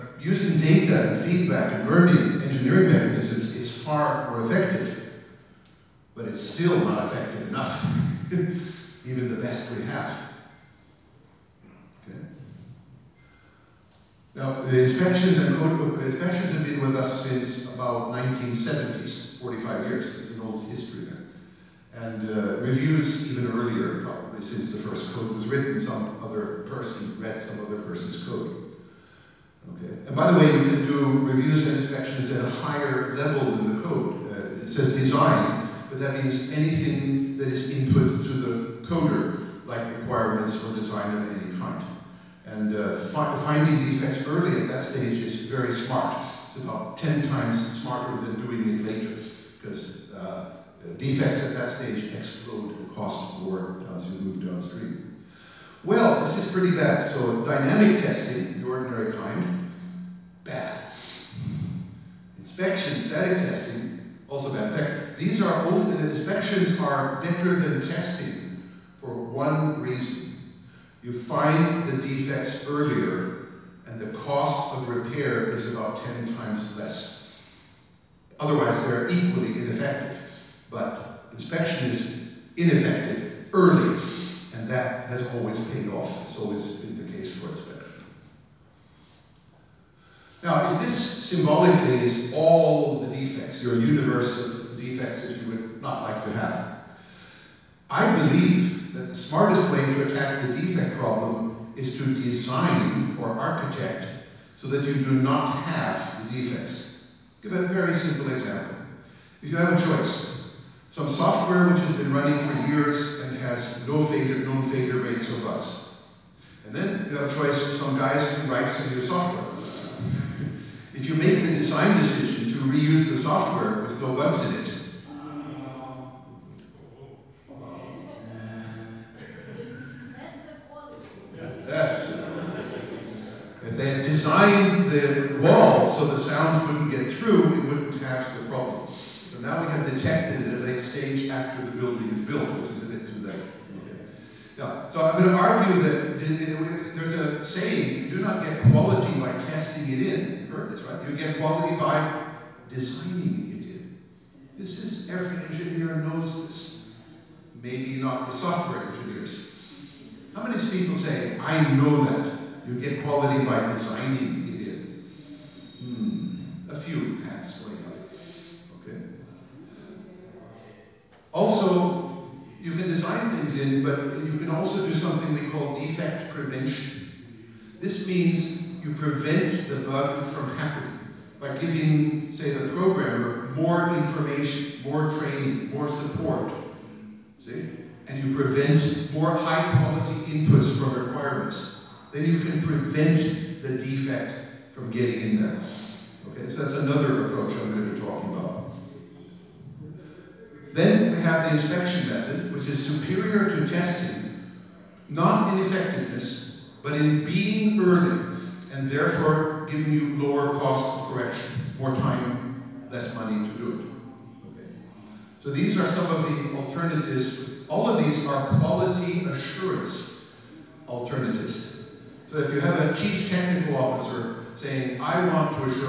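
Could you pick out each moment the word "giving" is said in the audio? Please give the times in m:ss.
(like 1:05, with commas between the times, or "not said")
3:01, 3:29.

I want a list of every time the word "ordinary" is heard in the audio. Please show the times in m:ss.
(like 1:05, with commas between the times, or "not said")
0:58.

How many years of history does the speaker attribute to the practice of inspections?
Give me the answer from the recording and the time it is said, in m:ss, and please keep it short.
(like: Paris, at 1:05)
45 years, at 0:19.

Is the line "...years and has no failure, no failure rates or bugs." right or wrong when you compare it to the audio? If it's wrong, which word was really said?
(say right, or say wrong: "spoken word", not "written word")
right.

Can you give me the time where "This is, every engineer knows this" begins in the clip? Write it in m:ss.
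2:34.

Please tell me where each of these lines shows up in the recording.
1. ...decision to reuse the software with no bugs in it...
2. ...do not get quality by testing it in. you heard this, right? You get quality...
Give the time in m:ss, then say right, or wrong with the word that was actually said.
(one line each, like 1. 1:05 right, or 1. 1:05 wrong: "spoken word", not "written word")
1. 2:02 right
2. 2:28 right.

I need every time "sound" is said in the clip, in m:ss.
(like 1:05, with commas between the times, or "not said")
2:16.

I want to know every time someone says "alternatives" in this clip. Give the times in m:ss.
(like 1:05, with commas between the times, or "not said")
3:36, 3:40.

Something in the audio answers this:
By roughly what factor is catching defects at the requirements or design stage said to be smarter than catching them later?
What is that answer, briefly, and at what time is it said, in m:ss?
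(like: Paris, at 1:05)
10 times, at 0:46.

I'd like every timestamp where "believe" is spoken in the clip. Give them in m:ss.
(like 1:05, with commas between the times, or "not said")
1:38.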